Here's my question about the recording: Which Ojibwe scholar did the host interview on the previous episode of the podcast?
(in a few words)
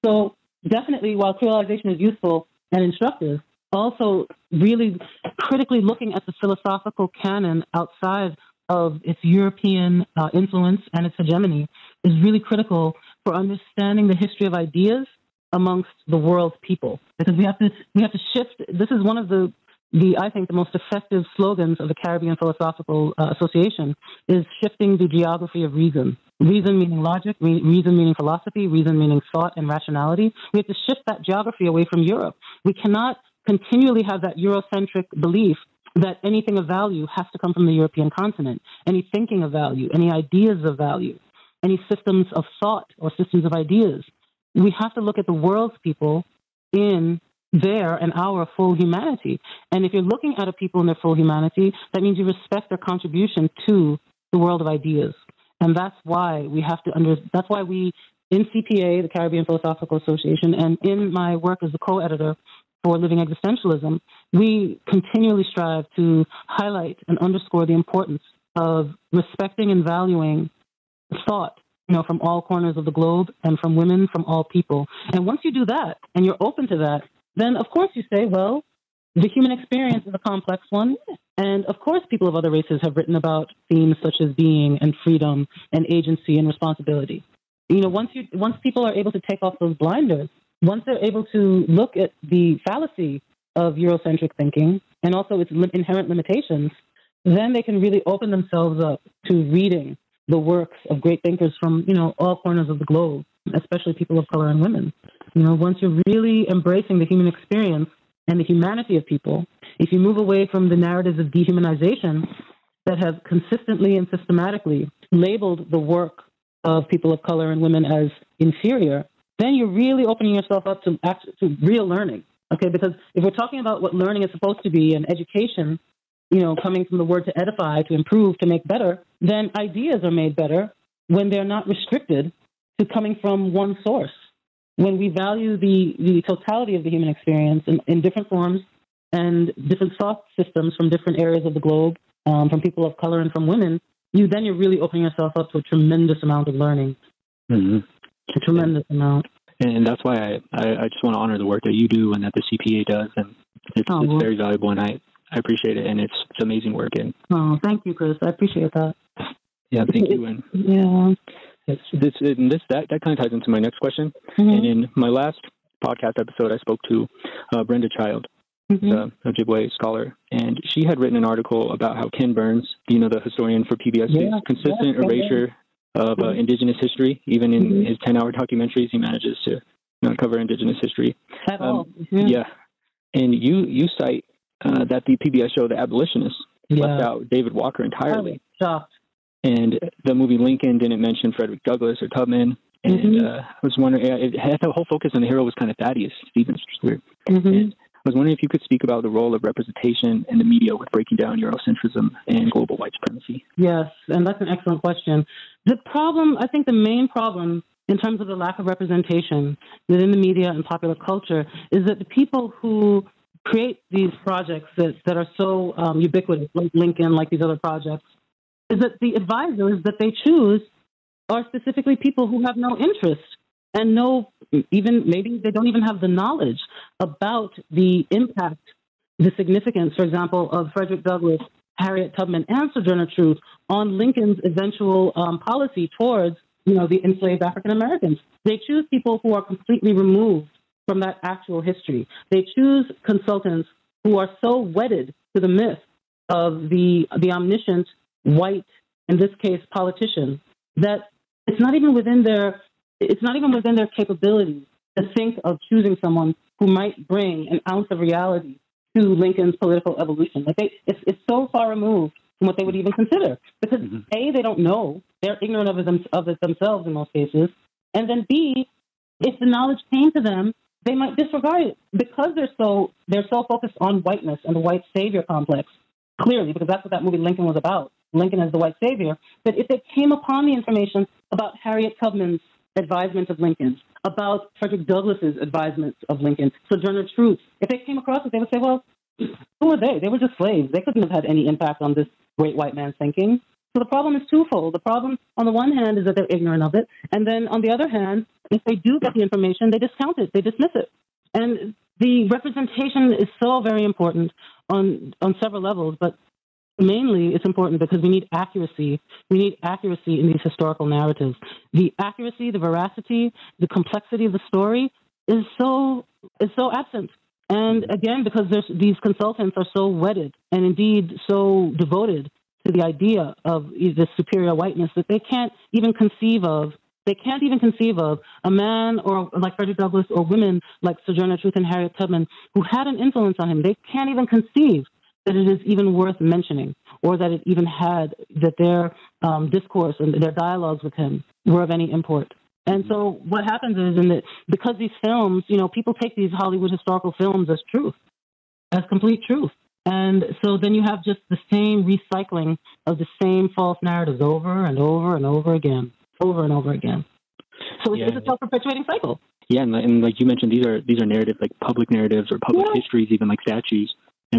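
Brenda Child.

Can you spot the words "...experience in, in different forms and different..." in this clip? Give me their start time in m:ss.
2:17.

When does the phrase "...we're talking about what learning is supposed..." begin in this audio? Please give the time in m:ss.
2:03.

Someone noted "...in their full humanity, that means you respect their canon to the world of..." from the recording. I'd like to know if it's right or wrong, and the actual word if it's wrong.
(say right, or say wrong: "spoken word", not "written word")
wrong: "contribution", not "canon".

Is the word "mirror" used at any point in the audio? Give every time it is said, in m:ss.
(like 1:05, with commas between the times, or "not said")
not said.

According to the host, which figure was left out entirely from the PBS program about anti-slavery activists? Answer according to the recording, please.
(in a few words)
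David Walker.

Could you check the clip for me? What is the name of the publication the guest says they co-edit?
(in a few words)
Living Existentialism.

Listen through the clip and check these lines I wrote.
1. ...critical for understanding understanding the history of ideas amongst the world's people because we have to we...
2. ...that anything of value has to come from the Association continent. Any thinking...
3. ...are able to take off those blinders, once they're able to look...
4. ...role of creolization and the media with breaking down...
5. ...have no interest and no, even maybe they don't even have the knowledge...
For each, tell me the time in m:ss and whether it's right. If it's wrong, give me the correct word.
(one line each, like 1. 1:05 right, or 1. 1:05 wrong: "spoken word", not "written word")
1. 0:12 right
2. 0:35 wrong: "European", not "Association"
3. 1:28 right
4. 3:19 wrong: "representation", not "creolization"
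5. 3:42 right.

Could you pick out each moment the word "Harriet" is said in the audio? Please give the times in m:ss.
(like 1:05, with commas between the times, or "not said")
3:51, 4:41, 5:31.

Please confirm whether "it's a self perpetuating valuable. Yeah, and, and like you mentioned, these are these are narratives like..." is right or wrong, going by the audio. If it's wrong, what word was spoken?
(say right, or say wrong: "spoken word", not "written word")
wrong: "cycle", not "valuable".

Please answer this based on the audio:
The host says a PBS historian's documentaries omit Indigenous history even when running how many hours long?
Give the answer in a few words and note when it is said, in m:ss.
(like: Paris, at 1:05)
10 hours, at 2:58.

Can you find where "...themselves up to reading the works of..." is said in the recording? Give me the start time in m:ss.
1:38.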